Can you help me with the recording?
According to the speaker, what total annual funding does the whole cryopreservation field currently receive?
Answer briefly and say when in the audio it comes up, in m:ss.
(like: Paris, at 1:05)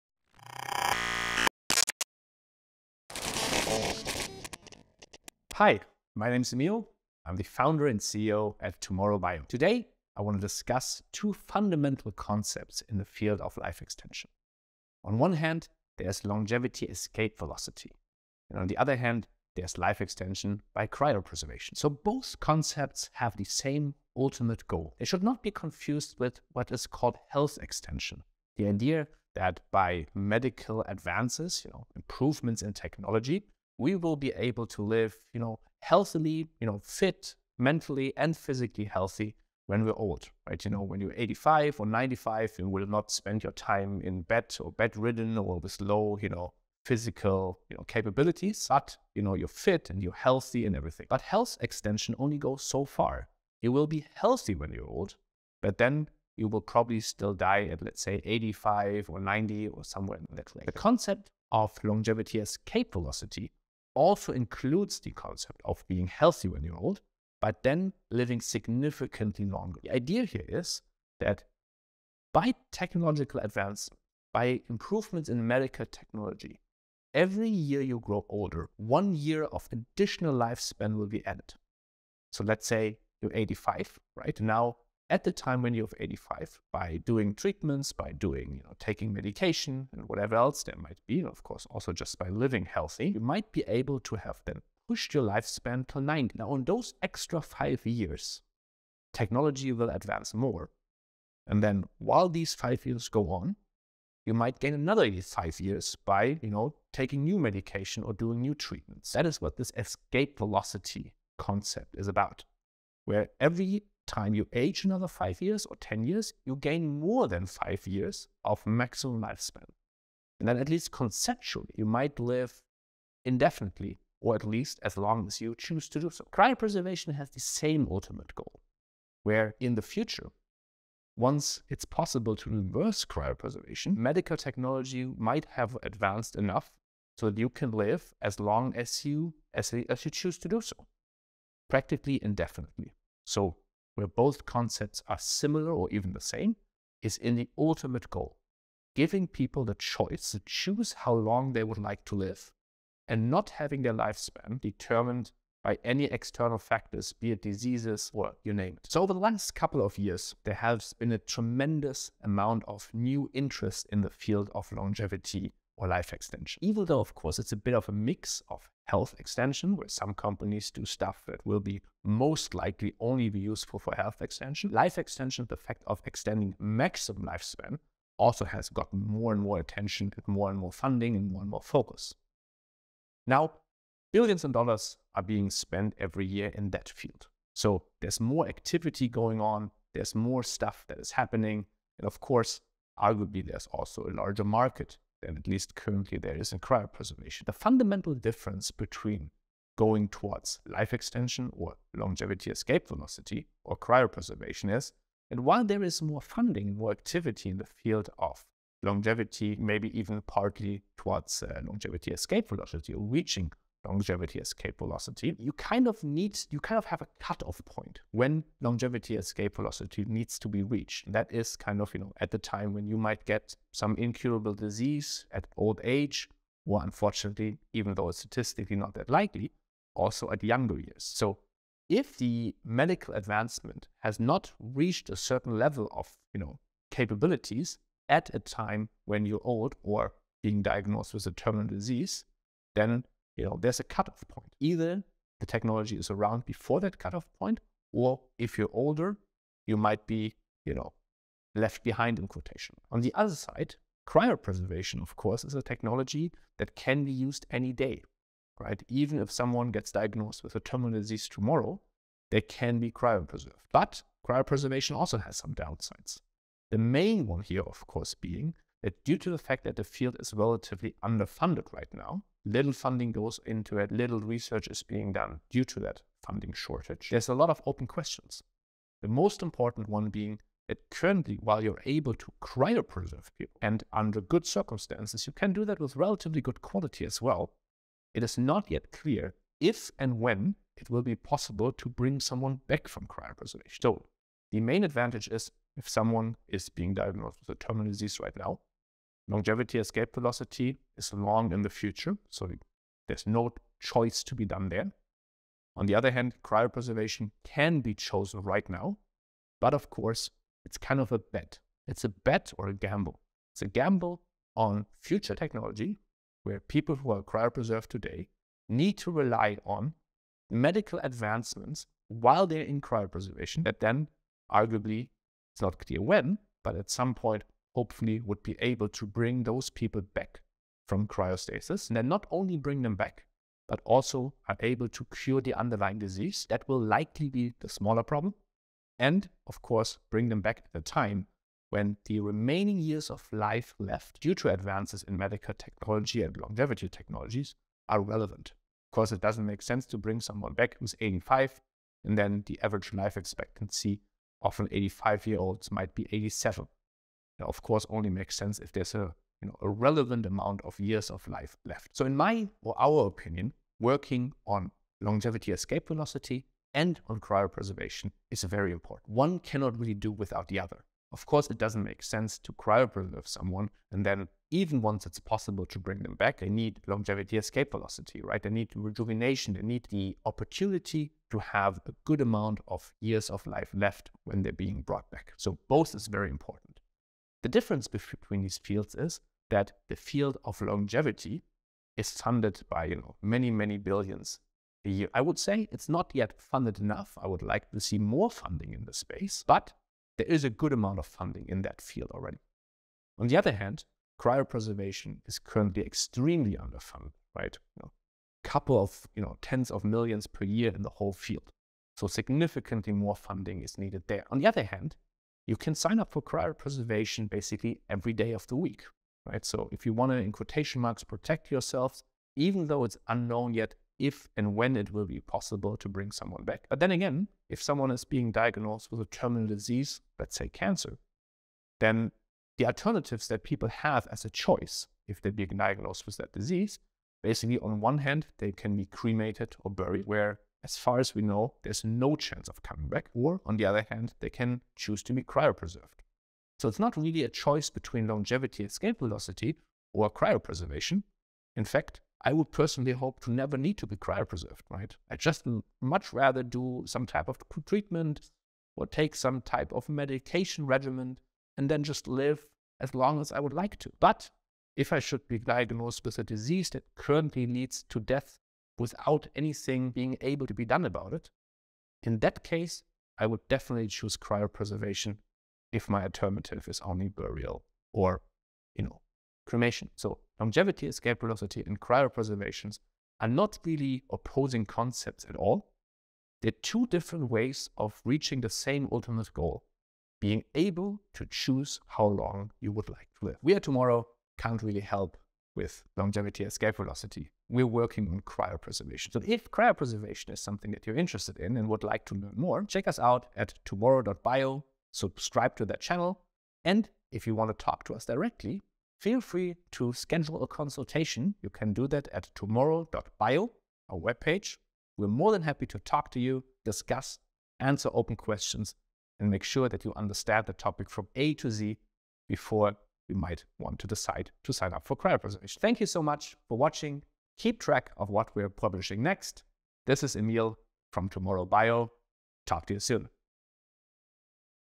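tens of millions, at 6:49.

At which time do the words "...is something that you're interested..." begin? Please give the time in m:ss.
8:20.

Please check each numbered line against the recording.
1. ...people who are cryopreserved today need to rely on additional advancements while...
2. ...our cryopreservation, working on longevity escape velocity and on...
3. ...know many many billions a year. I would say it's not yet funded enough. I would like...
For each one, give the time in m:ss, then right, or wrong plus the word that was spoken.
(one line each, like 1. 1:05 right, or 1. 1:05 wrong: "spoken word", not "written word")
1. 5:16 wrong: "medical", not "additional"
2. 6:02 wrong: "opinion", not "cryopreservation"
3. 6:32 right.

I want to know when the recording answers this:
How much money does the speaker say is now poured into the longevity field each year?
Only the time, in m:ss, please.
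3:04.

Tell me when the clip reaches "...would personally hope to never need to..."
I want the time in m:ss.
7:32.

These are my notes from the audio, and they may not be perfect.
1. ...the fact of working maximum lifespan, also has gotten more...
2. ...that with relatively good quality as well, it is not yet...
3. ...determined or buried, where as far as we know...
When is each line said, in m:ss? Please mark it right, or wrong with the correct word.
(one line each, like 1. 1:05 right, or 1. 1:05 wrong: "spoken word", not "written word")
1. 2:55 wrong: "extending", not "working"
2. 4:45 right
3. 7:18 wrong: "cremated", not "determined".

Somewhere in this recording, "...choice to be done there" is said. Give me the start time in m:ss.
5:03.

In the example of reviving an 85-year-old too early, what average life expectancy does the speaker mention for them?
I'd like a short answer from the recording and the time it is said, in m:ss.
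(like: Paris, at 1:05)
87, at 5:56.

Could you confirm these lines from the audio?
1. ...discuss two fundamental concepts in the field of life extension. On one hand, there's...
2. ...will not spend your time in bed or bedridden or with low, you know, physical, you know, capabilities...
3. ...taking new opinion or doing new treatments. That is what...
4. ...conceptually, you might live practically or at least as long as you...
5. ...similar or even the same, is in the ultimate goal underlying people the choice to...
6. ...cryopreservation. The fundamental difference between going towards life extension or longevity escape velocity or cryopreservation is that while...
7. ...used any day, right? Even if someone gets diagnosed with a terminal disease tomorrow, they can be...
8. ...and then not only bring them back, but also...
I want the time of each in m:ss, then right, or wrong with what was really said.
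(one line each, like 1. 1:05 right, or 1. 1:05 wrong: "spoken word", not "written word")
1. 0:10 right
2. 0:42 right
3. 1:46 wrong: "medication", not "opinion"
4. 2:00 wrong: "indefinitely", not "practically"
5. 2:25 wrong: "giving", not "underlying"
6. 3:16 right
7. 4:17 right
8. 5:31 right.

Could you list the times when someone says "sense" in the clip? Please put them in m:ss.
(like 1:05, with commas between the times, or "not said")
5:49, 5:58, 6:12.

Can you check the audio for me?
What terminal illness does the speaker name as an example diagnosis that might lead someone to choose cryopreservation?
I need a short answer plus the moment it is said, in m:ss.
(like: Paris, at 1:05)
cancer, at 7:10.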